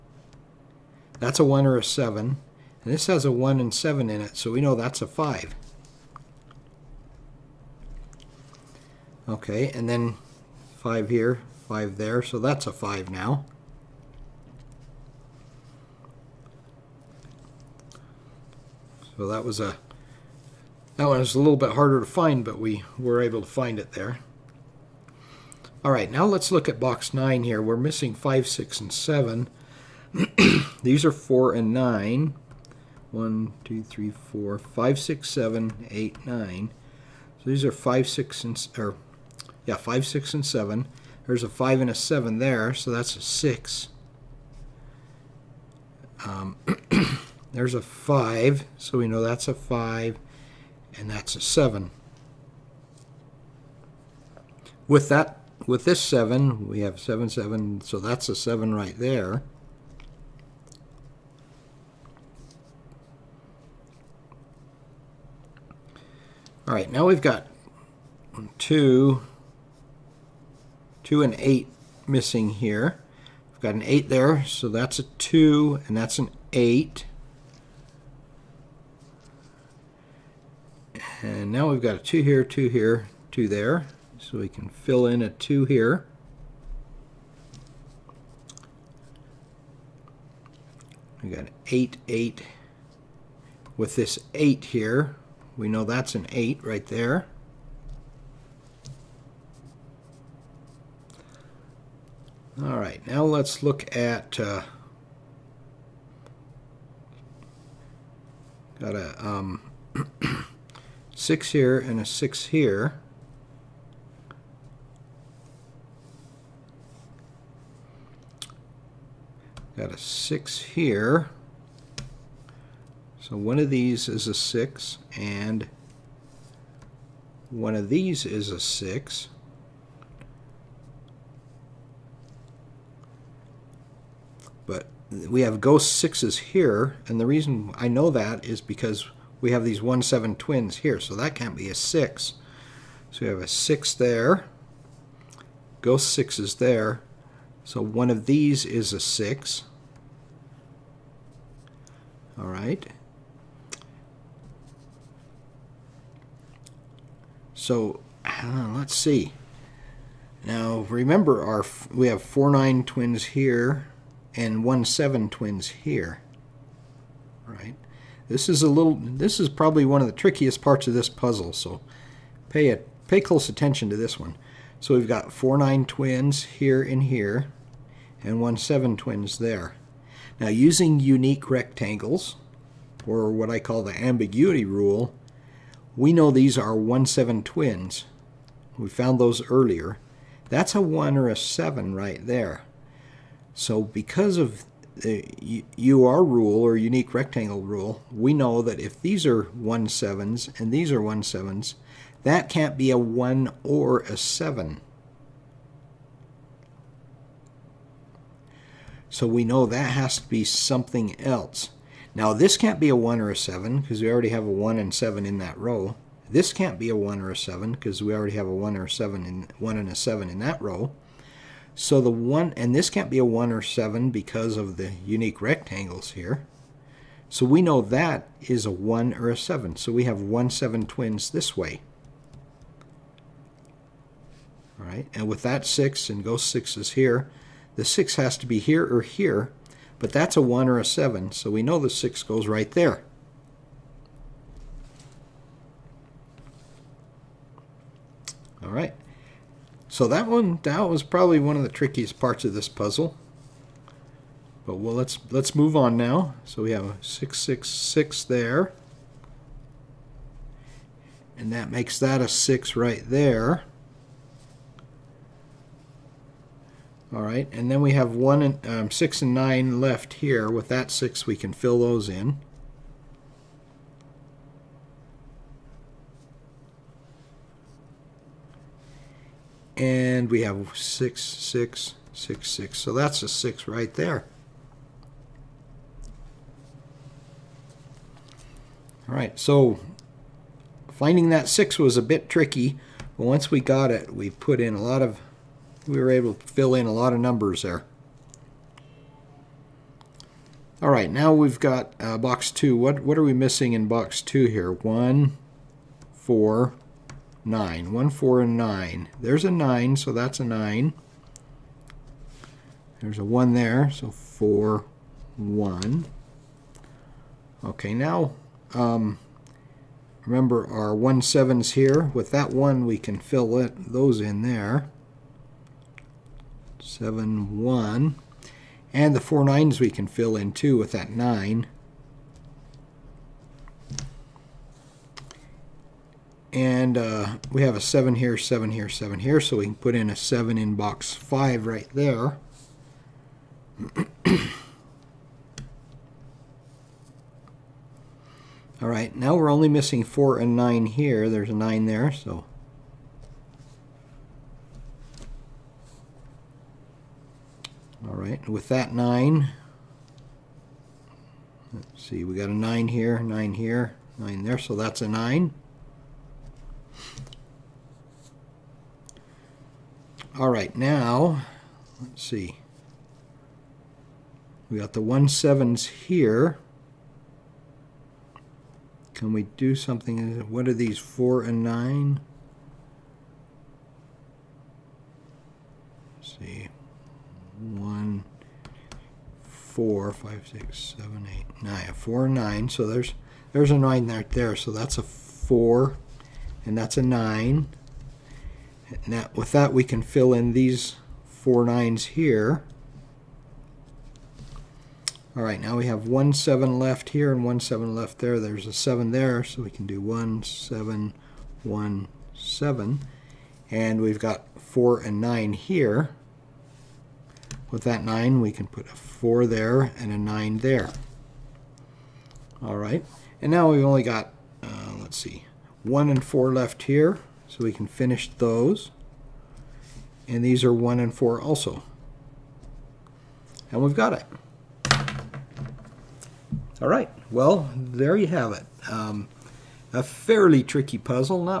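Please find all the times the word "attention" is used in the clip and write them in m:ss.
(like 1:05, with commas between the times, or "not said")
2:53.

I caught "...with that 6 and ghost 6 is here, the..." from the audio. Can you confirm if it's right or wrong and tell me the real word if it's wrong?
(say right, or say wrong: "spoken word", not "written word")
right.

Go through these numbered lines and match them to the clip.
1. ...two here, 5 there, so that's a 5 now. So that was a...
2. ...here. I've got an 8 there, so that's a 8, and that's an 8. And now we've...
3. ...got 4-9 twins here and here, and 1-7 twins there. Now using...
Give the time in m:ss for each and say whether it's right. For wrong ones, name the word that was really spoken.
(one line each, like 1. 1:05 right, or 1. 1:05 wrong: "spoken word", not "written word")
1. 0:10 wrong: "five", not "two"
2. 1:12 wrong: "2", not "8"
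3. 2:55 right.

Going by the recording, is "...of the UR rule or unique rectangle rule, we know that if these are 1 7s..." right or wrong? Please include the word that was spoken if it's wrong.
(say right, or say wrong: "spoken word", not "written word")
right.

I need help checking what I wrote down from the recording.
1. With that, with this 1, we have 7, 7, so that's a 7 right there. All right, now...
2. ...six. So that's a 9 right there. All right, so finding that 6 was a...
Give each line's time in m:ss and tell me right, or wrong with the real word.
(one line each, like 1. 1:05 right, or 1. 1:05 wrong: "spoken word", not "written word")
1. 0:54 wrong: "7", not "1"
2. 4:42 wrong: "6", not "9".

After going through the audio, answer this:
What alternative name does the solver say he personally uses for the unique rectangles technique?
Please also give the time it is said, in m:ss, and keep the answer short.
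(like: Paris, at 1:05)
the ambiguity rule, at 3:03.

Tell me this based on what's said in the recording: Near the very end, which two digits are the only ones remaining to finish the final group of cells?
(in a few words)
1 and 4.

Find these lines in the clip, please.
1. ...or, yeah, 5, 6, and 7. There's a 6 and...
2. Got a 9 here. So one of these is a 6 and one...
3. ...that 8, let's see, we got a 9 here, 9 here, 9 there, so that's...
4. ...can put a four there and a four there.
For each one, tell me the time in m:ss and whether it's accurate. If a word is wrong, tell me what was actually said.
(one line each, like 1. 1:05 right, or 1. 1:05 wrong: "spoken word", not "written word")
1. 0:38 wrong: "5", not "6"
2. 1:59 wrong: "6", not "9"
3. 5:58 wrong: "9", not "8"
4. 6:58 wrong: "nine", not "four".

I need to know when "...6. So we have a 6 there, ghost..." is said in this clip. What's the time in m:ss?
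2:21.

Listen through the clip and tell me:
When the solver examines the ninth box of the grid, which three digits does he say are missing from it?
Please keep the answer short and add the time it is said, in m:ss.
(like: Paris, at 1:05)
5, 6, and 7, at 0:27.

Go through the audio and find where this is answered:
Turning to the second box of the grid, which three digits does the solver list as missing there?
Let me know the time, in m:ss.
5:07.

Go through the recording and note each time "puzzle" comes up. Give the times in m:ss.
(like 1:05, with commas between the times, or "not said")
2:51, 4:12, 7:20.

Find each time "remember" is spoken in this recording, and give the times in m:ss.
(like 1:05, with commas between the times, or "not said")
2:40, 5:20.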